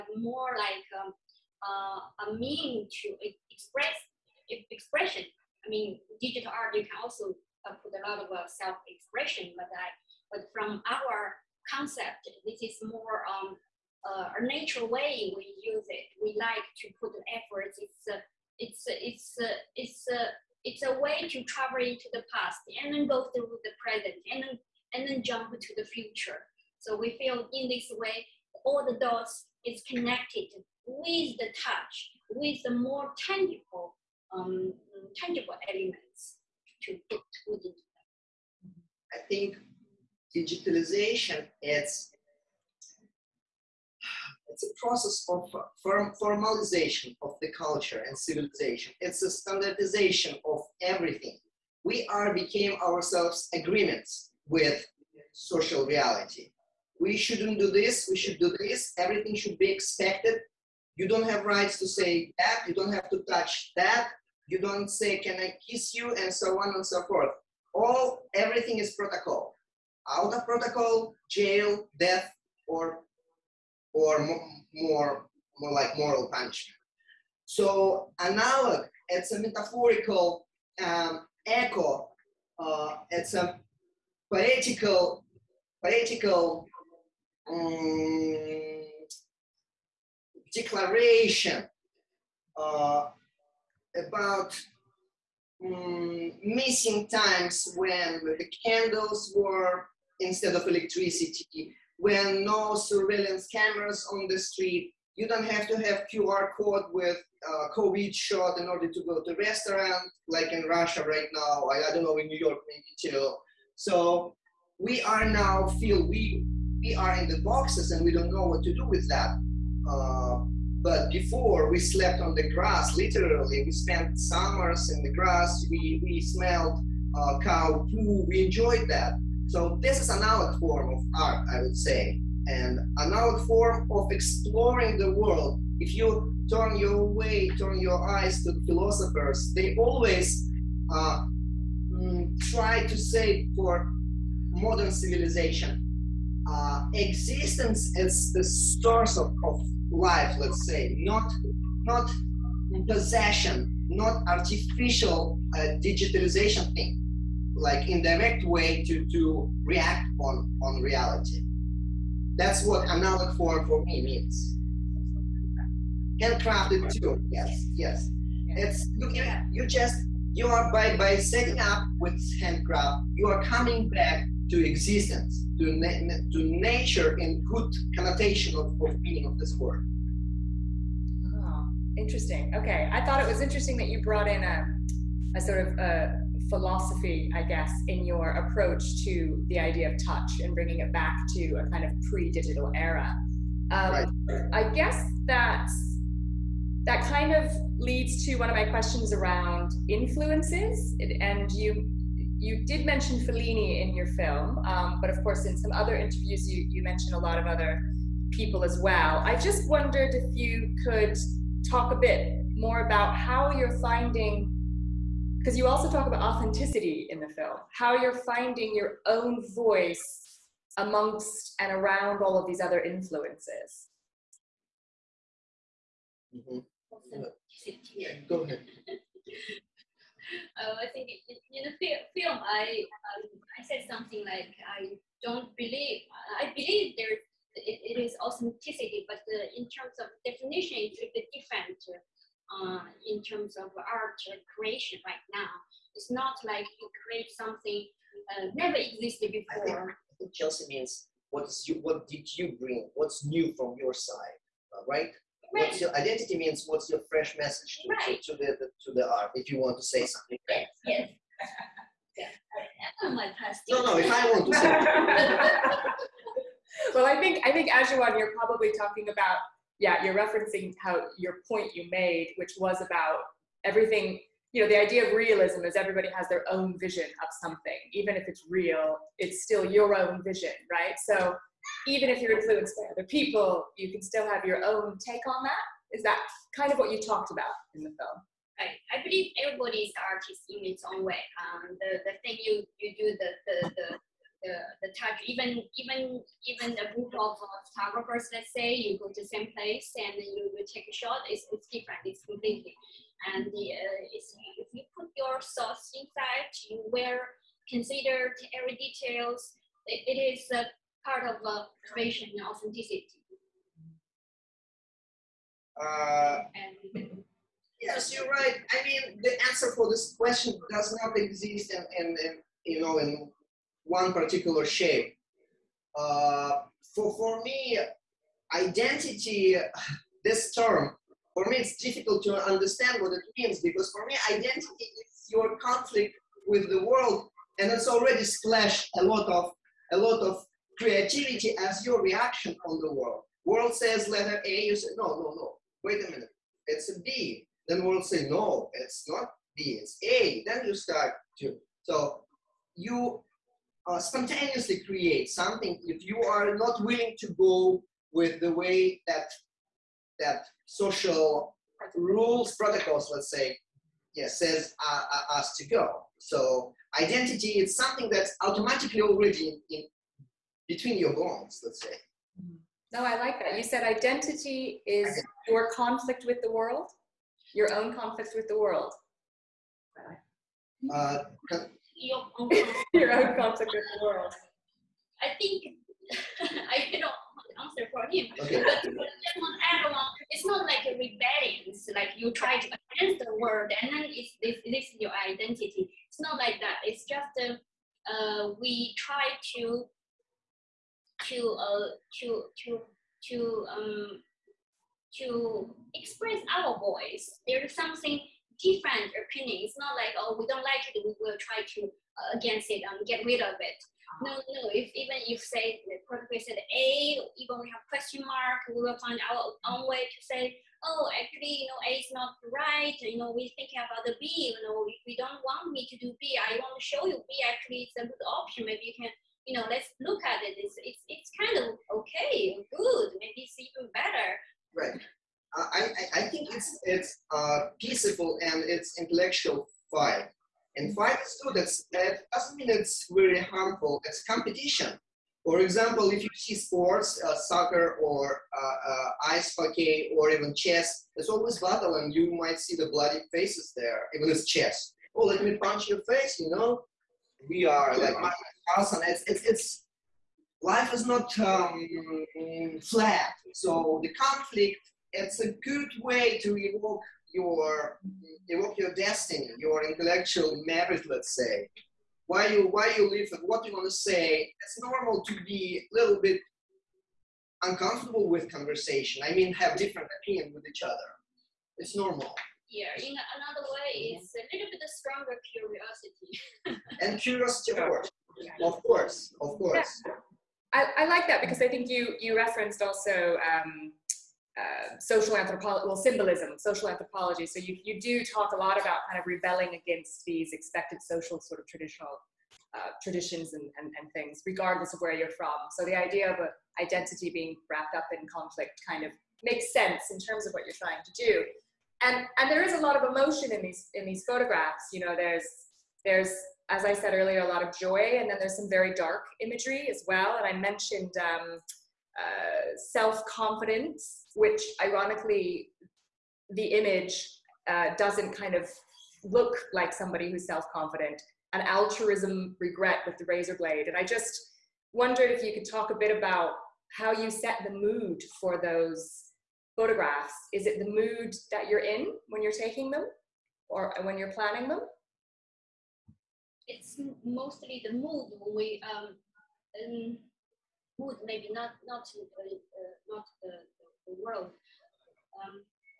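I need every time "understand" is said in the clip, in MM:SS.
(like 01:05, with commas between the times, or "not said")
05:32.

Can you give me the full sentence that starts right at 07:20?
And fight students, that doesn't mean it's very harmful.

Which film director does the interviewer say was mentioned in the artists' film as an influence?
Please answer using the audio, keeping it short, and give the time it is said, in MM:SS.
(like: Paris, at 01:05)
Fellini, at 03:23.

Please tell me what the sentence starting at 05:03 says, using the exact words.
And the, uh, it's, if you put your thoughts inside, you will consider every details.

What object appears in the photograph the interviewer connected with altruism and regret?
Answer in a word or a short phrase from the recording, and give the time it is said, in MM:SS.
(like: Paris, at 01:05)
razor blade, at 08:53.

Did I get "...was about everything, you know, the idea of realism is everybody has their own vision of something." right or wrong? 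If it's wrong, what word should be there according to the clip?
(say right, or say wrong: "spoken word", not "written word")
right.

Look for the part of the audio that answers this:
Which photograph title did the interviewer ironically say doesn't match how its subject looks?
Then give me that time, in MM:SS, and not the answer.
08:42.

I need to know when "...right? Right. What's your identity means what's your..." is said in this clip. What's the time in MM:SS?
04:14.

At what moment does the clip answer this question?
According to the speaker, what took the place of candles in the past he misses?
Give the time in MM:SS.
01:40.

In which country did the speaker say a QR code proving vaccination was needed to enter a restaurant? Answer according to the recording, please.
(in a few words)
Russia.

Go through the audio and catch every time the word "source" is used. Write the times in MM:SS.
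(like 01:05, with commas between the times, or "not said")
02:28.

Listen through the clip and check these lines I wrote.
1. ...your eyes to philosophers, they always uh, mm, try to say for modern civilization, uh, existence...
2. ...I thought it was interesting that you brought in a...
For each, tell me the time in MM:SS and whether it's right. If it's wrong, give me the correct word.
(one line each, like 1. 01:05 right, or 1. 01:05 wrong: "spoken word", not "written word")
1. 02:17 right
2. 03:02 right.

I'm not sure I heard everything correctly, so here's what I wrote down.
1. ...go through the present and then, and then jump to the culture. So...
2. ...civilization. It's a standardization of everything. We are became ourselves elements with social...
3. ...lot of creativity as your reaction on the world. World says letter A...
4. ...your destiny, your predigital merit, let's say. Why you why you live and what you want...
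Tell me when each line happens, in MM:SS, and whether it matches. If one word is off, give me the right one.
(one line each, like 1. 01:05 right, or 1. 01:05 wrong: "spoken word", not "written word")
1. 00:23 wrong: "future", not "culture"
2. 00:48 wrong: "agreements", not "elements"
3. 05:39 right
4. 07:48 wrong: "intellectual", not "predigital".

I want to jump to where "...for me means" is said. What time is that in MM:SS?
02:43.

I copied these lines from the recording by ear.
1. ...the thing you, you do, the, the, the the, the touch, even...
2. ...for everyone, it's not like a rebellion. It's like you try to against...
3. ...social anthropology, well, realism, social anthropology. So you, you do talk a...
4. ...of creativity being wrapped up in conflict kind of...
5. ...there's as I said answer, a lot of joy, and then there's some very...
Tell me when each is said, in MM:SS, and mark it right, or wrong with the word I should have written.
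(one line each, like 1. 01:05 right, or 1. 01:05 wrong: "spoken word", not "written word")
1. 04:52 right
2. 06:28 right
3. 08:14 wrong: "symbolism", not "realism"
4. 08:26 wrong: "identity", not "creativity"
5. 08:36 wrong: "earlier", not "answer".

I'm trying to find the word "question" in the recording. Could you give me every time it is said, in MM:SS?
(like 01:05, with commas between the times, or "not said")
03:18, 05:20, 06:57.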